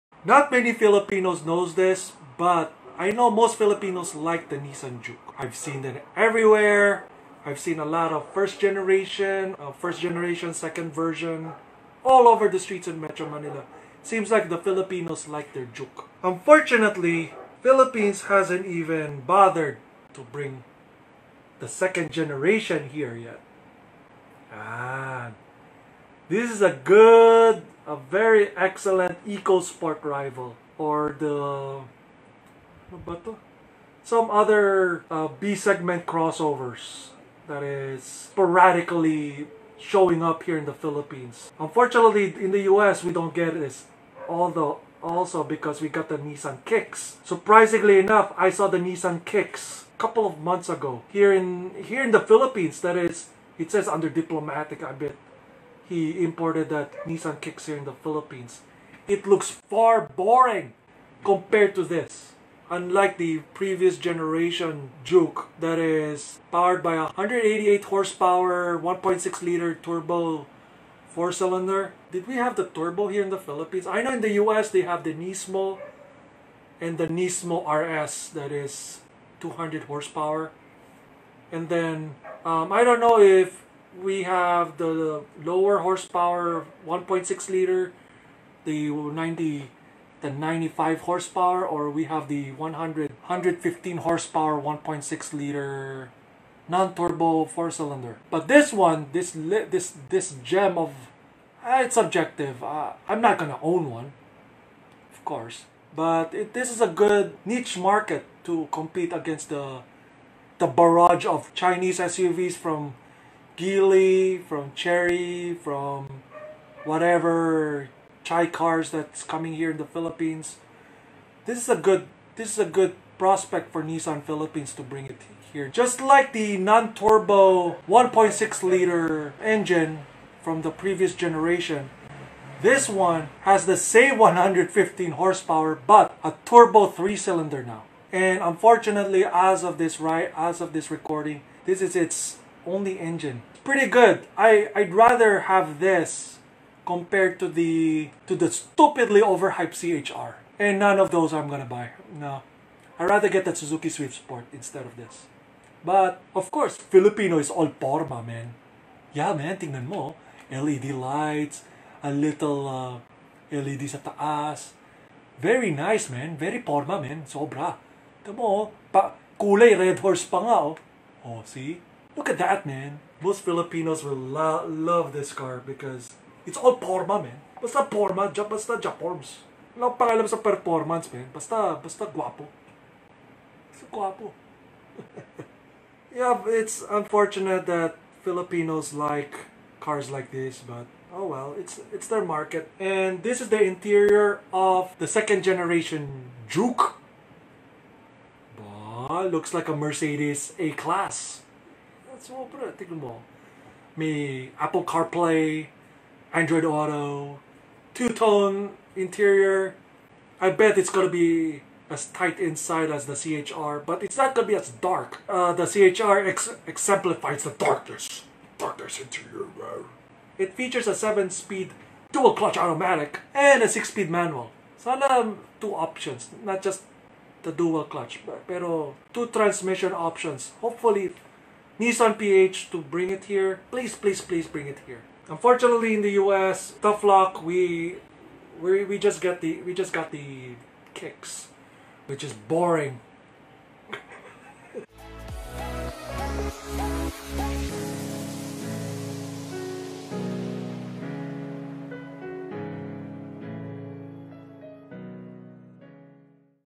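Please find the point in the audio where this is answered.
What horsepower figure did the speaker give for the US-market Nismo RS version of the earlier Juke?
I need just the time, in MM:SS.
01:19.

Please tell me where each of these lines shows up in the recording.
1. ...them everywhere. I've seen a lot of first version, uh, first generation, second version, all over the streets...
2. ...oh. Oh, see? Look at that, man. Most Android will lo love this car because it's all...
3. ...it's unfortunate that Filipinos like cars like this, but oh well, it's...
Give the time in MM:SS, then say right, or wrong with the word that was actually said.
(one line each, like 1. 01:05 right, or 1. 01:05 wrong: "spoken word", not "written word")
1. 00:05 wrong: "generation", not "version"
2. 02:50 wrong: "Filipinos", not "Android"
3. 03:06 right.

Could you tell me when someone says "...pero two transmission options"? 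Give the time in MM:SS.
03:48.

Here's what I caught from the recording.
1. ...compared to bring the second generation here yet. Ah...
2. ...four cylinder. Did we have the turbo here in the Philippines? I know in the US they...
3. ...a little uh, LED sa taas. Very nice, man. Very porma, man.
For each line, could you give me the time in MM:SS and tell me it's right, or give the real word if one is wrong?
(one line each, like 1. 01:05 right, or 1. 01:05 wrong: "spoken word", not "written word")
1. 00:19 wrong: "bothered", not "compared"
2. 01:11 right
3. 02:42 right.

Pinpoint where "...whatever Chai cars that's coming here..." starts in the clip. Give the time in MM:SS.
01:56.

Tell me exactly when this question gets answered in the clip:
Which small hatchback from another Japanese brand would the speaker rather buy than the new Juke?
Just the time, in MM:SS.
02:33.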